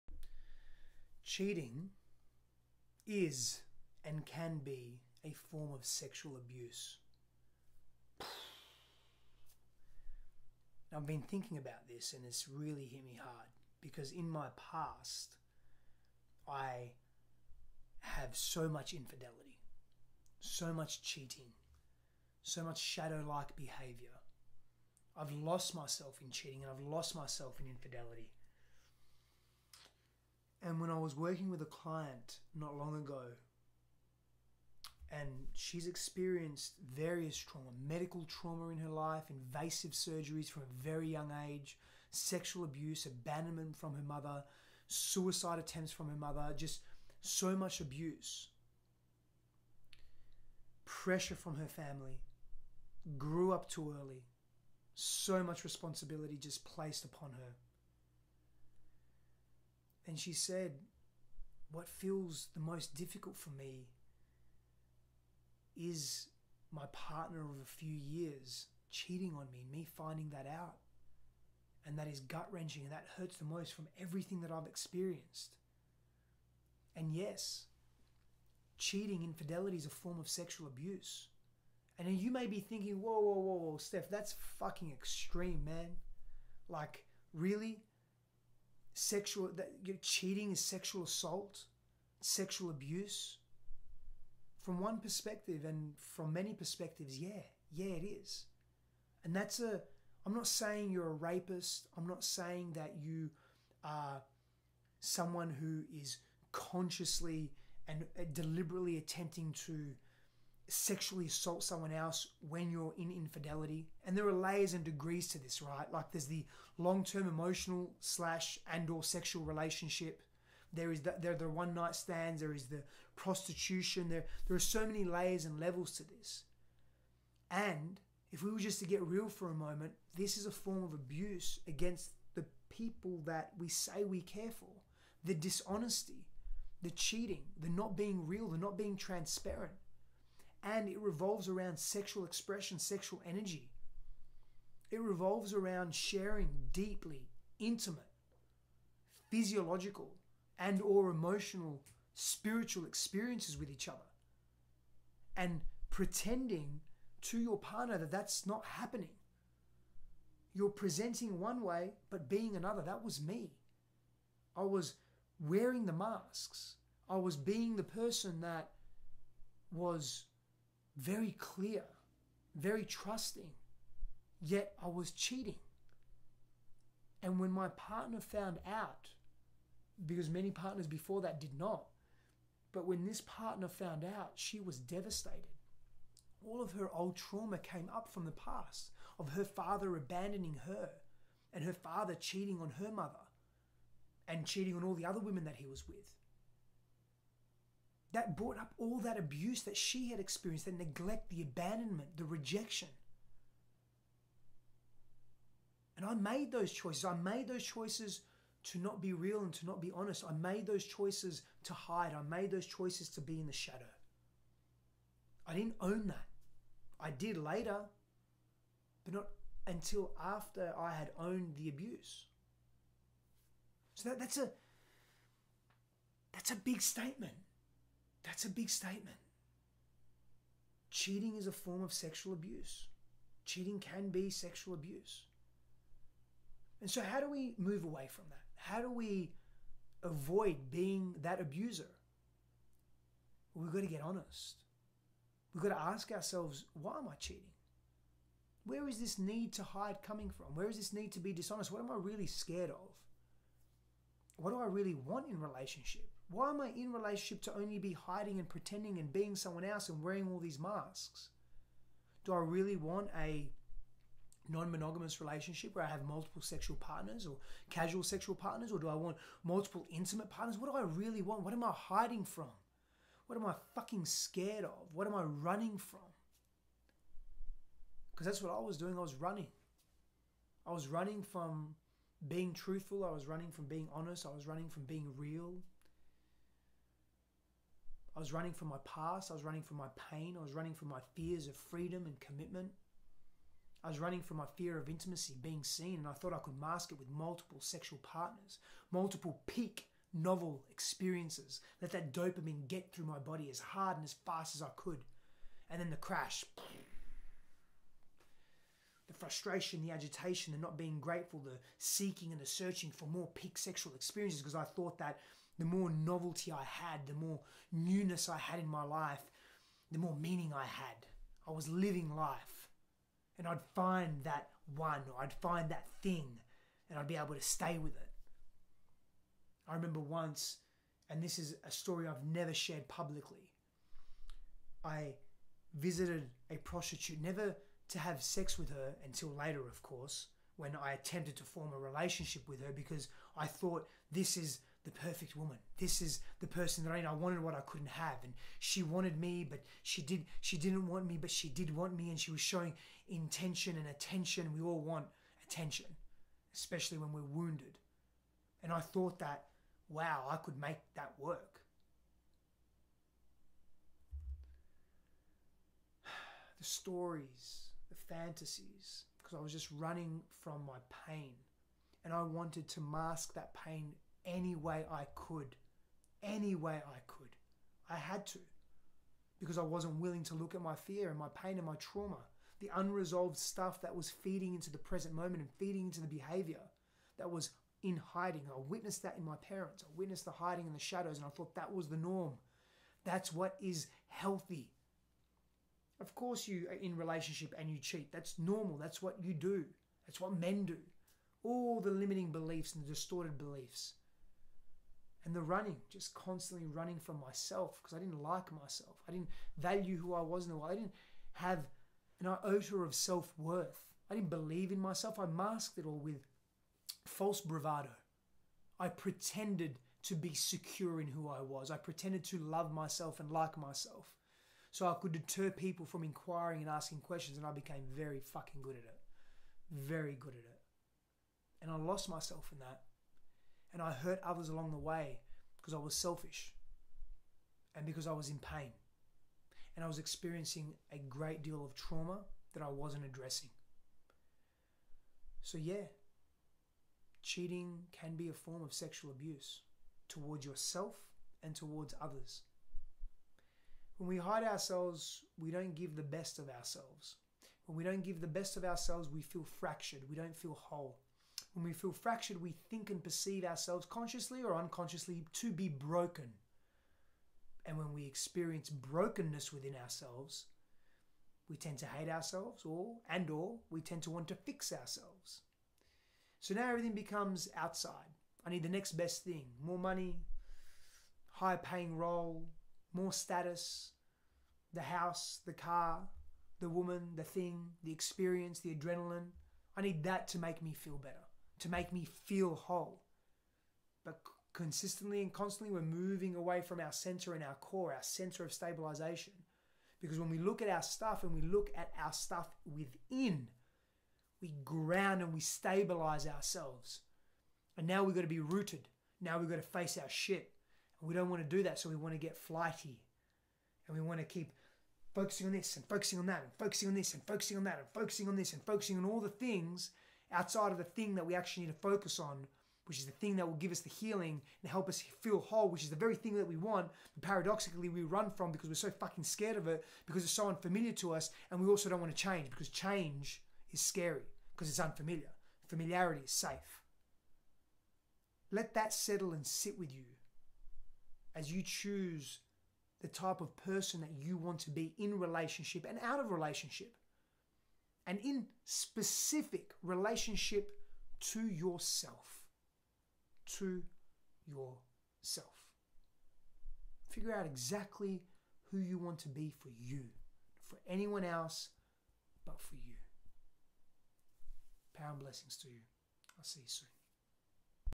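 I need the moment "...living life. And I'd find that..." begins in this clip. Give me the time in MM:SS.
05:21.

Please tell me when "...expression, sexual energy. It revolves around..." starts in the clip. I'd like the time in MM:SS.
02:22.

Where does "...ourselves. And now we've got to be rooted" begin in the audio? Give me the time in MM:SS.
08:26.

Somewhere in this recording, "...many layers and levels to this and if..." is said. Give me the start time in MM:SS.
02:04.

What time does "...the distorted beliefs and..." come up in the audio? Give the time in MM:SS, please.
06:42.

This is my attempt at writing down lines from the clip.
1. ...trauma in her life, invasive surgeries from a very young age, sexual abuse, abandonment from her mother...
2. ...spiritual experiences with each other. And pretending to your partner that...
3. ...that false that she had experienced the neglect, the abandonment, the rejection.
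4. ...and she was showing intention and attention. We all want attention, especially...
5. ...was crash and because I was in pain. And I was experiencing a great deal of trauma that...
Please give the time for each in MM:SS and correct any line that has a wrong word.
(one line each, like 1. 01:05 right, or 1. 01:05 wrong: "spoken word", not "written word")
1. 00:38 right
2. 02:32 right
3. 03:18 wrong: "abuse", not "false"
4. 05:52 right
5. 07:15 wrong: "selfish", not "crash".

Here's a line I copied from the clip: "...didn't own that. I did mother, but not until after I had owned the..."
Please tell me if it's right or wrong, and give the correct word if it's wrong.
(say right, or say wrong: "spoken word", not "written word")
wrong: "later", not "mother".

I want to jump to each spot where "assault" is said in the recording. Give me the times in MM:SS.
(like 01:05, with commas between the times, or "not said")
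01:31, 01:51.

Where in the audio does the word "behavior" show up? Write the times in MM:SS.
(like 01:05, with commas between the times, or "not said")
00:23, 06:26.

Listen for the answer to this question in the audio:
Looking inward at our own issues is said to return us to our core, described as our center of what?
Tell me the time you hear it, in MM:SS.
08:18.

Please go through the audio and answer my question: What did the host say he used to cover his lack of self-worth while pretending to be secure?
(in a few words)
False bravado.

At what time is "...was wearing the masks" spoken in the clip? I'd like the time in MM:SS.
02:44.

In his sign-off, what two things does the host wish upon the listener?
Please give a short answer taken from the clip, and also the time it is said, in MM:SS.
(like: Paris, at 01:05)
Power and blessings, at 09:24.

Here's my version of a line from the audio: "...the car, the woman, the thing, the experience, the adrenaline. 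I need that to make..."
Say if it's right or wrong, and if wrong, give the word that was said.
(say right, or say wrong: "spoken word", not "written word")
right.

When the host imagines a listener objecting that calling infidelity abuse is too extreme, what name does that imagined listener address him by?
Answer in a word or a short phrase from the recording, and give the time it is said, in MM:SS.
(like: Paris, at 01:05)
Steph, at 01:23.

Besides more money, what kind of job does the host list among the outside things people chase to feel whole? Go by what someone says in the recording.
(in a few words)
High paying role.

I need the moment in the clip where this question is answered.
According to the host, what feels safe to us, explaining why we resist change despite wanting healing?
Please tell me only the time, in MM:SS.
08:55.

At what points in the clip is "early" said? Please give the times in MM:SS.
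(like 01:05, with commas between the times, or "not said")
00:53.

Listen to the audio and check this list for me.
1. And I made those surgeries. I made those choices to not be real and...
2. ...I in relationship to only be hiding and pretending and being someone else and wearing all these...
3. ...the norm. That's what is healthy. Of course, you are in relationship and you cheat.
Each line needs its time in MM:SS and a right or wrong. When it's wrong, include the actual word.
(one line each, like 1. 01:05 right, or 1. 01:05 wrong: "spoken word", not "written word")
1. 03:25 wrong: "choices", not "surgeries"
2. 04:16 right
3. 06:31 right.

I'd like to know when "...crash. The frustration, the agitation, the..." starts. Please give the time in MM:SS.
05:05.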